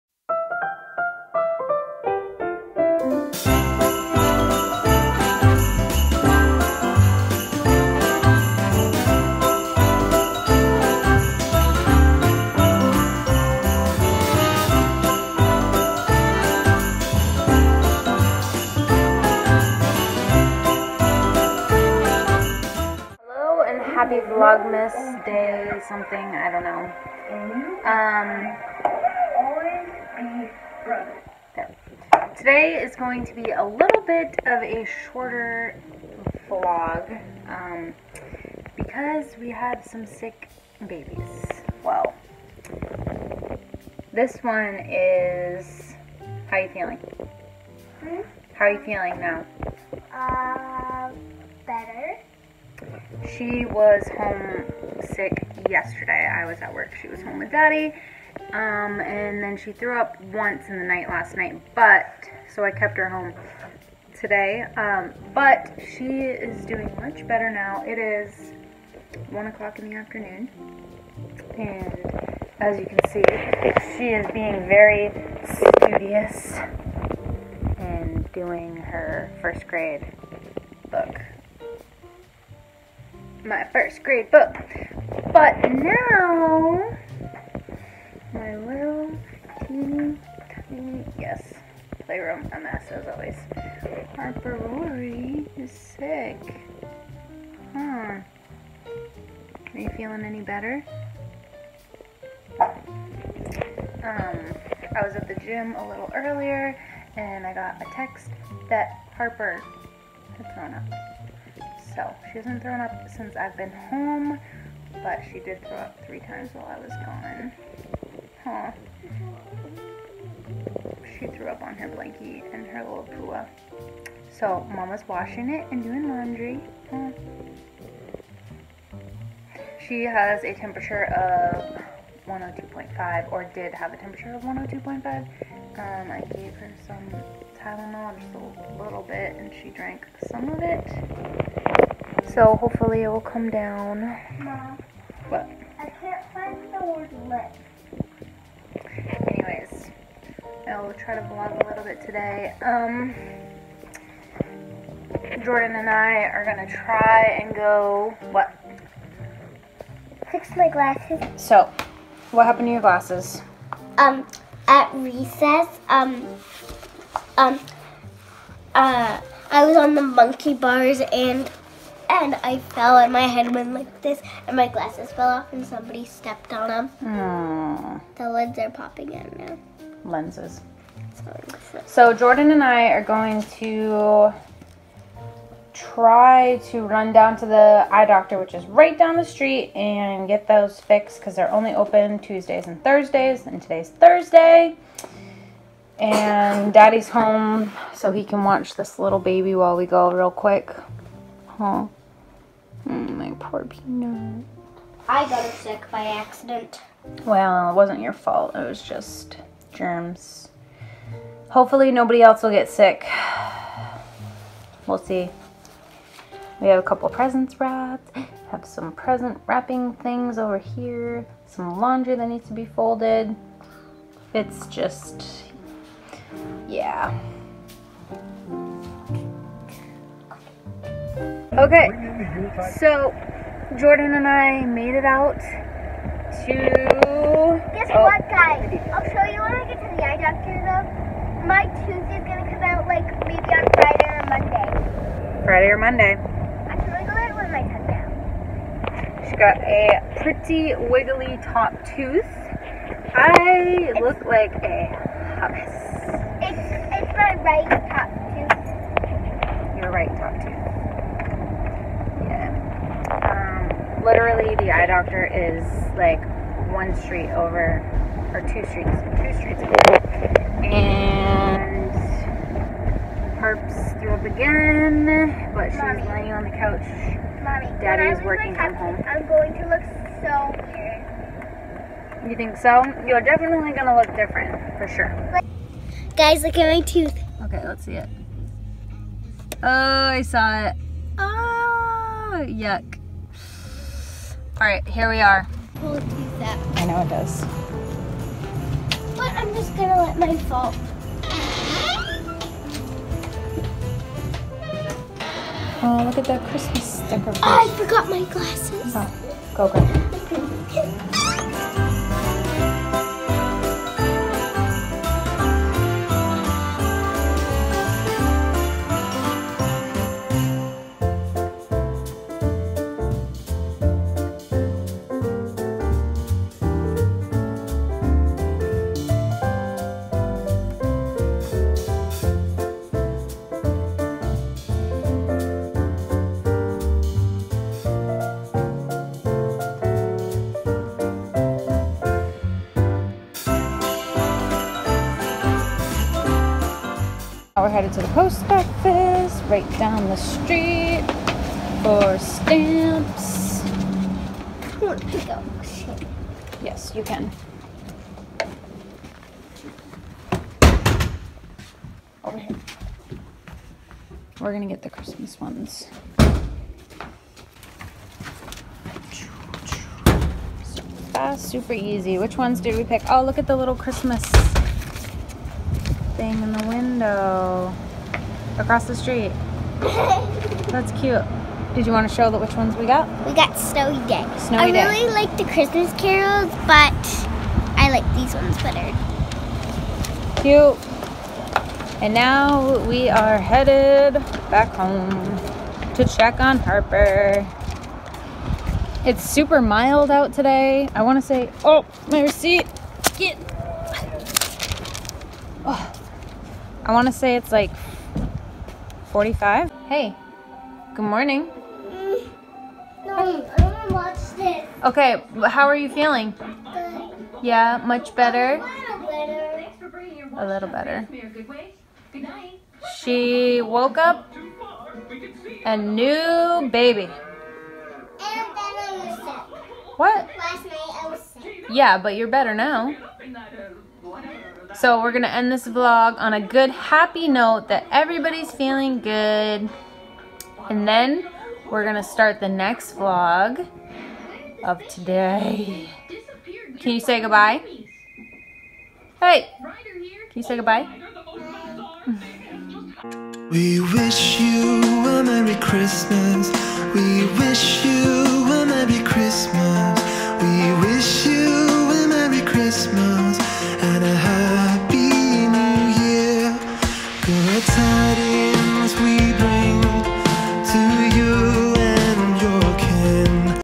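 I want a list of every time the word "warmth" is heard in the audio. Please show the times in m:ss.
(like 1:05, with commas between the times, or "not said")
not said.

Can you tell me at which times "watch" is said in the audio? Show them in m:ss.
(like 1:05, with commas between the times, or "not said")
3:18, 6:53.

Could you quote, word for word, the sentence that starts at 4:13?
I it's, look like a hummus.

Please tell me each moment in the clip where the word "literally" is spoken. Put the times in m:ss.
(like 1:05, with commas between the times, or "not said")
4:24.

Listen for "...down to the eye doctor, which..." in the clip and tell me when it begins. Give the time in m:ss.
3:07.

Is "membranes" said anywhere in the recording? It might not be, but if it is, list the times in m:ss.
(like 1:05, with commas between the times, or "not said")
not said.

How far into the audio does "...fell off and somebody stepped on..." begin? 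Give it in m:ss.
2:55.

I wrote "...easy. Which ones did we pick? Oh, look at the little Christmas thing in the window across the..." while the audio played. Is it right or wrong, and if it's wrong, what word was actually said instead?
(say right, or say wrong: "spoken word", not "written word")
right.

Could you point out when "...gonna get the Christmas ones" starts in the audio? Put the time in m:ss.
6:04.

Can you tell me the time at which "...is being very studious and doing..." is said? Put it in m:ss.
1:14.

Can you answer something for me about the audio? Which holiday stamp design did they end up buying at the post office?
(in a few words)
Snowy Day.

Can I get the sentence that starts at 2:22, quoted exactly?
So hopefully it will come down.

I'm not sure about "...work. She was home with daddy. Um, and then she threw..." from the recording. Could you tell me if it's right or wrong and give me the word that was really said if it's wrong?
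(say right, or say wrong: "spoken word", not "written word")
right.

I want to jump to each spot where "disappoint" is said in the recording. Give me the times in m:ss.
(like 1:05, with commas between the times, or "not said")
not said.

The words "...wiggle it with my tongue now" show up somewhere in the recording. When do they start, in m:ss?
4:06.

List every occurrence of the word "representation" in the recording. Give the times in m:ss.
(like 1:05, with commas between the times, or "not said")
not said.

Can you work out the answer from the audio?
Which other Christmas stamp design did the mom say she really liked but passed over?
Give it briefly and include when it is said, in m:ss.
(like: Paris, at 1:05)
Christmas carols, at 6:25.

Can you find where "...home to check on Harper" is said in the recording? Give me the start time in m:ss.
6:34.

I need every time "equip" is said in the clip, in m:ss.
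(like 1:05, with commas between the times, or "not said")
not said.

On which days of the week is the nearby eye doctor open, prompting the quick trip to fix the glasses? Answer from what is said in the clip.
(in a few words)
Tuesdays and Thursdays.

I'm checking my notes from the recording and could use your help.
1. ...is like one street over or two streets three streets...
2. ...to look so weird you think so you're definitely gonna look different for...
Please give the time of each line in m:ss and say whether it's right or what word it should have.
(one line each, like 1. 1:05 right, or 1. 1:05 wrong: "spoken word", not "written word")
1. 4:25 wrong: "two", not "three"
2. 4:39 right.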